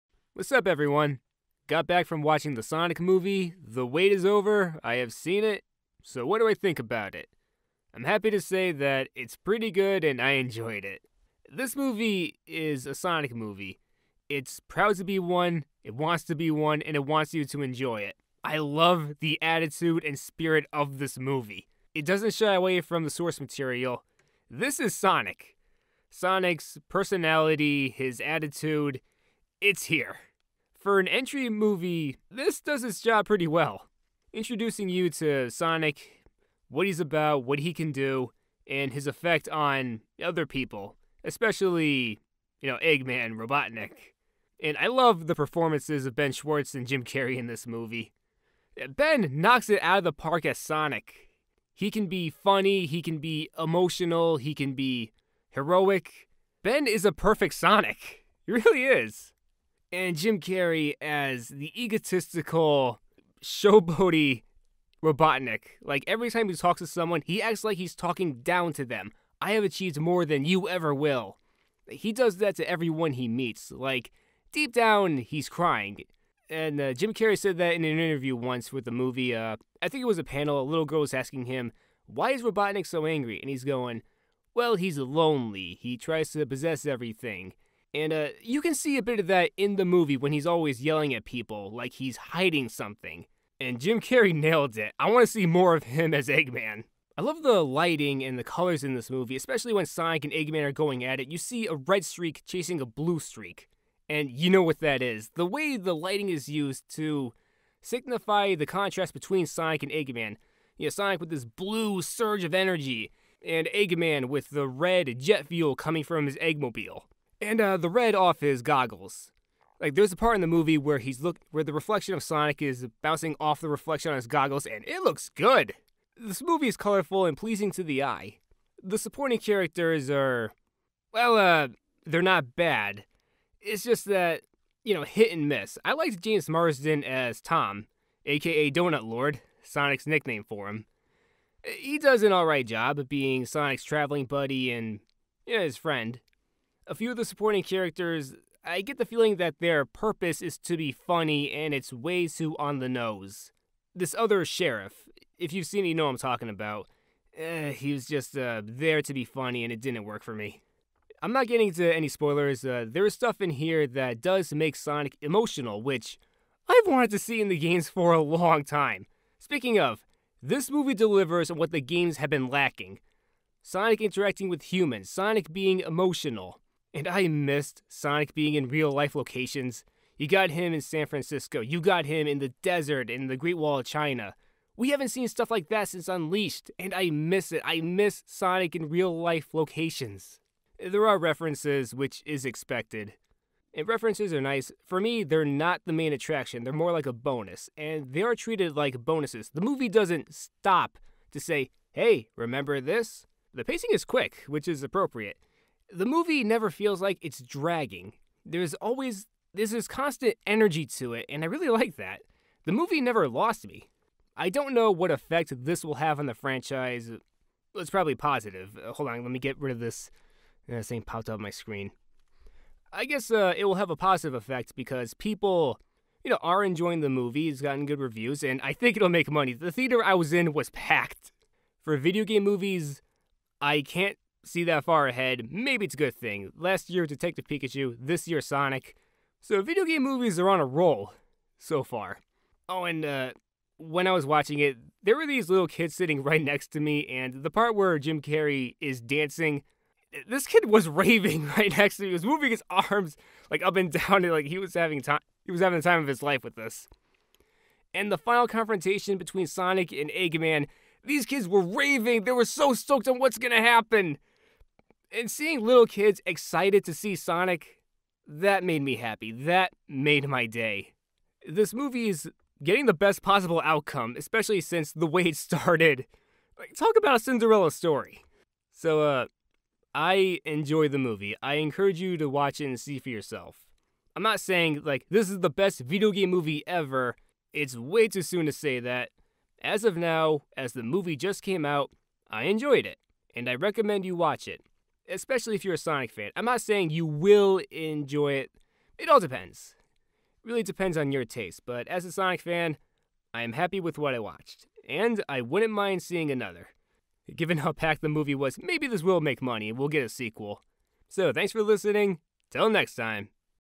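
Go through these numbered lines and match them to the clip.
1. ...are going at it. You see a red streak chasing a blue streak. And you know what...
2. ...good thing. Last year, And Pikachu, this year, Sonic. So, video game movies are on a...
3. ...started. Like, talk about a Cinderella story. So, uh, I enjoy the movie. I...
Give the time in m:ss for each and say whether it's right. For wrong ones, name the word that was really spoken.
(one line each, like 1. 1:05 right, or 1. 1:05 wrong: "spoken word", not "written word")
1. 1:40 right
2. 3:55 wrong: "Detective", not "And"
3. 4:35 right.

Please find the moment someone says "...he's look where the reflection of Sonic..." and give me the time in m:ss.
2:00.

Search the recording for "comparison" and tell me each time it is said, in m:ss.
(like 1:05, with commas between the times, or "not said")
not said.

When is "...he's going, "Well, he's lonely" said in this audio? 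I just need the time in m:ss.
1:23.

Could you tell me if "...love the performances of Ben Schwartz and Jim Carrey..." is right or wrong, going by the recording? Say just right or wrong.
right.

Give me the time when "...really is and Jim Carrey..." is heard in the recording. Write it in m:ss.
0:58.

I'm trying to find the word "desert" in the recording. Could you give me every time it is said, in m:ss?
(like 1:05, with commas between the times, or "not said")
3:02.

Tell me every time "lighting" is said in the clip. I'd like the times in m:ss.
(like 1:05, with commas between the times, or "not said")
1:37, 1:45.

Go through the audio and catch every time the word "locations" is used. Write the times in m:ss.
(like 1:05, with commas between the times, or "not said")
2:59, 3:09.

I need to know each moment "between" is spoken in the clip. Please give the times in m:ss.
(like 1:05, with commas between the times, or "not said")
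1:49, 4:19.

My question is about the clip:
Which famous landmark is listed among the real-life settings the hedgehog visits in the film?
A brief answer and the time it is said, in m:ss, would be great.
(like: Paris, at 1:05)
Great Wall of China, at 3:03.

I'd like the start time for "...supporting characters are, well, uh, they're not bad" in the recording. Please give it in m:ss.
2:08.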